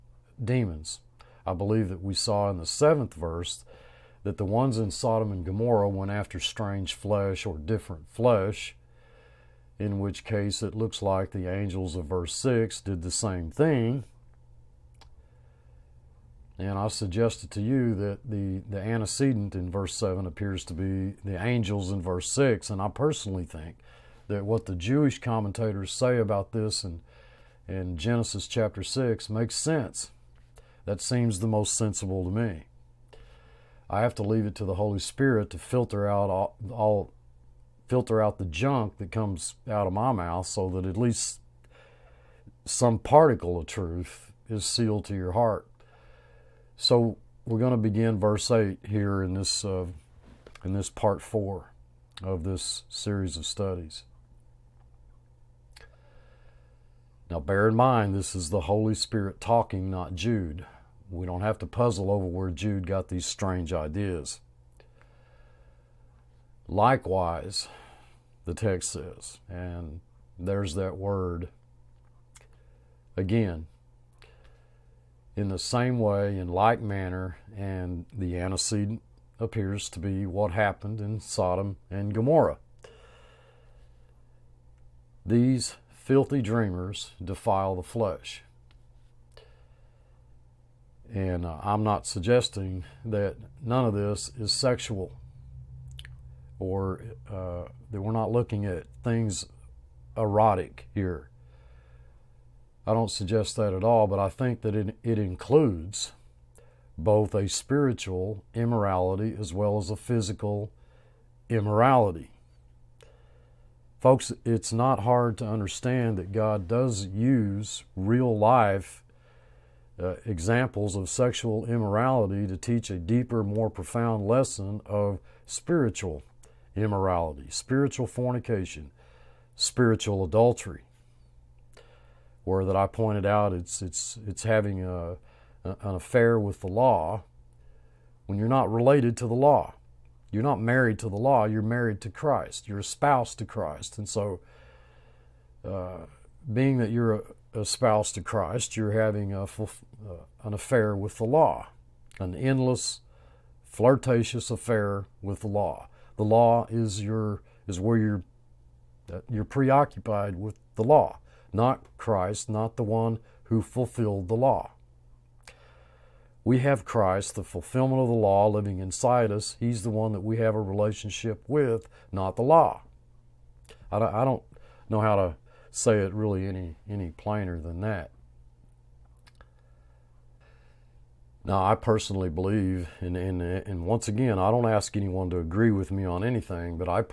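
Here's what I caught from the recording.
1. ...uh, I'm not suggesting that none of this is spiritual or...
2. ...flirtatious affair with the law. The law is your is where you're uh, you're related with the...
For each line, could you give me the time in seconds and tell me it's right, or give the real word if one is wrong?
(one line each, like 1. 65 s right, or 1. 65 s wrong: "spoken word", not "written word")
1. 91 s wrong: "sexual", not "spiritual"
2. 153 s wrong: "preoccupied", not "related".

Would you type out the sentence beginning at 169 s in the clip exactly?
He's the one that we have a relationship with, not the law.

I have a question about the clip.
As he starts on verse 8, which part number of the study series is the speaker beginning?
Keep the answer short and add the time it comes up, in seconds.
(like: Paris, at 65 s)
4, at 50 s.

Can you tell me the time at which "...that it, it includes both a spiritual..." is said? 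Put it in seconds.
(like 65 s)
104 s.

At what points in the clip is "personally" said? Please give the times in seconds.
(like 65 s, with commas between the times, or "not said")
22 s, 181 s.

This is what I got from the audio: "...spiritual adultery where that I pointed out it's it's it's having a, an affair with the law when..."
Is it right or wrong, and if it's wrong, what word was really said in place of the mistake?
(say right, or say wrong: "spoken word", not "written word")
right.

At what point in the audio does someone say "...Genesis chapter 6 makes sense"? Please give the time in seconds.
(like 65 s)
27 s.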